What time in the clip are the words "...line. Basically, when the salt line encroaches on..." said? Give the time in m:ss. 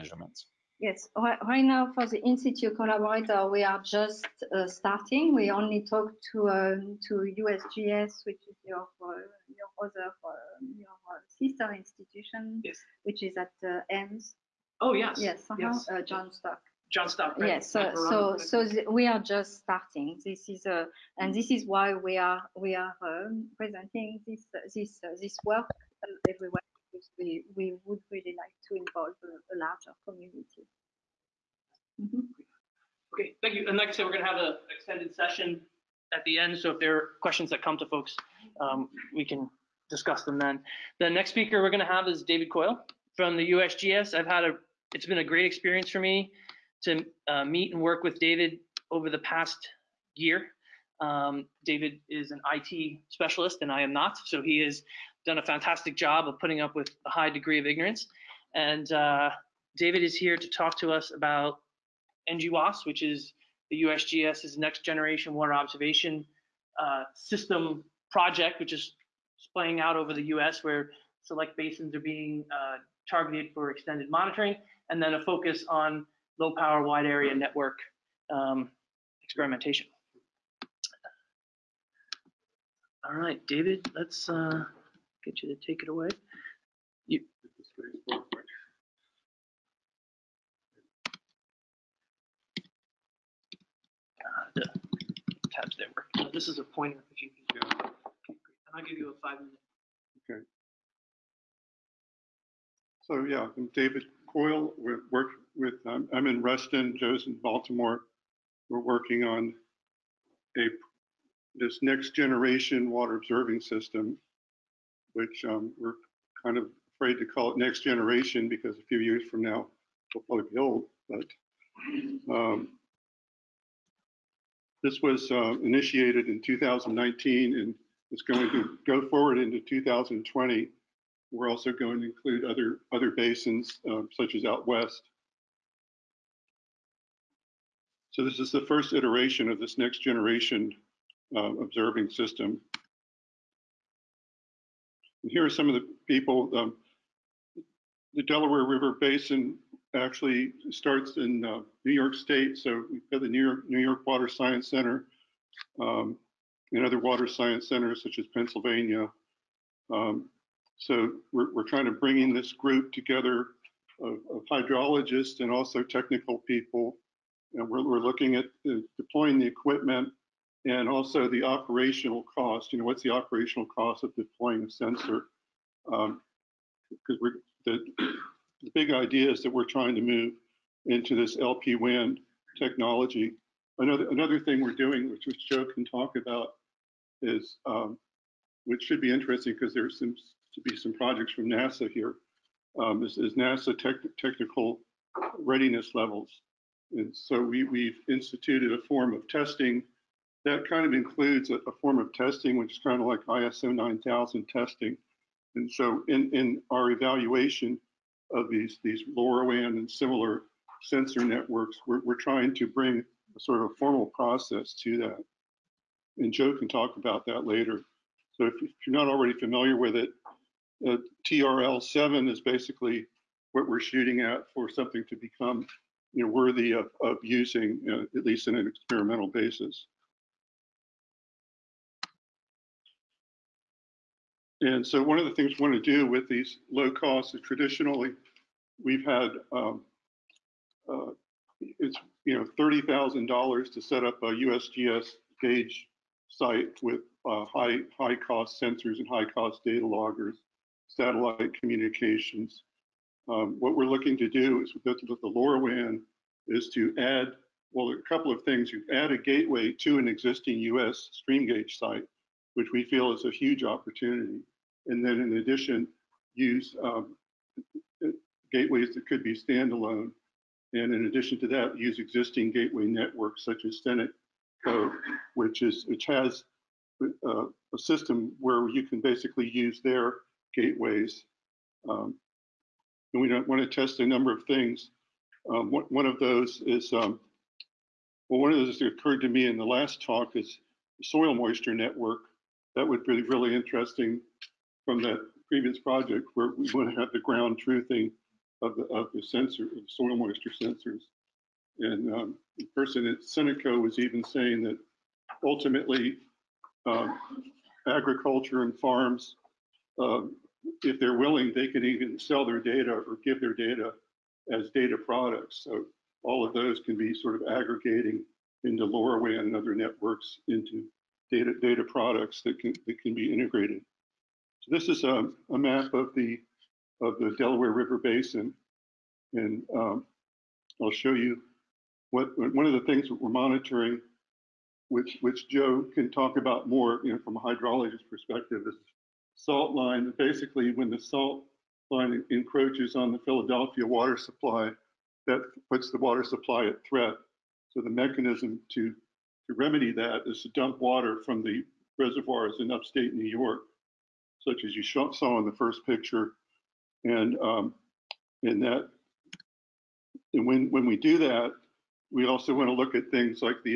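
5:39.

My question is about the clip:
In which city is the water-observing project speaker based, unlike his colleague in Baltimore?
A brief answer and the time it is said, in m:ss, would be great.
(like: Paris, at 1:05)
Reston, at 1:46.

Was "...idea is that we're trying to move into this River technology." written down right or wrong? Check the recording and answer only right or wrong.
wrong.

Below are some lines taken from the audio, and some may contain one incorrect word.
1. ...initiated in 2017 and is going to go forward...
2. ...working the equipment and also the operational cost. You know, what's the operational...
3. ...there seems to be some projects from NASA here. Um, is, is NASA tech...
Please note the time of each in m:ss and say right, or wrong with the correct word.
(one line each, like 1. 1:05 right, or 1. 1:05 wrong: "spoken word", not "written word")
1. 2:05 wrong: "2019", not "2017"
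2. 2:48 wrong: "deploying", not "working"
3. 3:09 right.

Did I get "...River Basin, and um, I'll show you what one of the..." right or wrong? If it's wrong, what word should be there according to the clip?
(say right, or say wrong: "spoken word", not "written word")
right.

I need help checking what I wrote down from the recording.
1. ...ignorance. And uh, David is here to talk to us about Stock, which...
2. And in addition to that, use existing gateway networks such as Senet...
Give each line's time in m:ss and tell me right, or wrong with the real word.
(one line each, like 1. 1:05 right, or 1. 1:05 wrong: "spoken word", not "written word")
1. 0:57 wrong: "NGWOS", not "Stock"
2. 4:30 right.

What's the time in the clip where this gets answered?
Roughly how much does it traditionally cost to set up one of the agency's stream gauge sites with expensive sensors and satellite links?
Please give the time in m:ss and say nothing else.
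4:02.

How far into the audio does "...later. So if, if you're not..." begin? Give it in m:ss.
3:37.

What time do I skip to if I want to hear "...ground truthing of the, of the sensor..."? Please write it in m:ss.
4:57.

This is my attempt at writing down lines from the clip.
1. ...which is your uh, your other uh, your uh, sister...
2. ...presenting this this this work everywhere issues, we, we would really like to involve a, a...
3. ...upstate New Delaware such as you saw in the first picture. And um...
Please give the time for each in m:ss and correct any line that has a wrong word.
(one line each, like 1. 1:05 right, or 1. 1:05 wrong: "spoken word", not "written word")
1. 0:08 right
2. 0:23 right
3. 5:52 wrong: "York", not "Delaware".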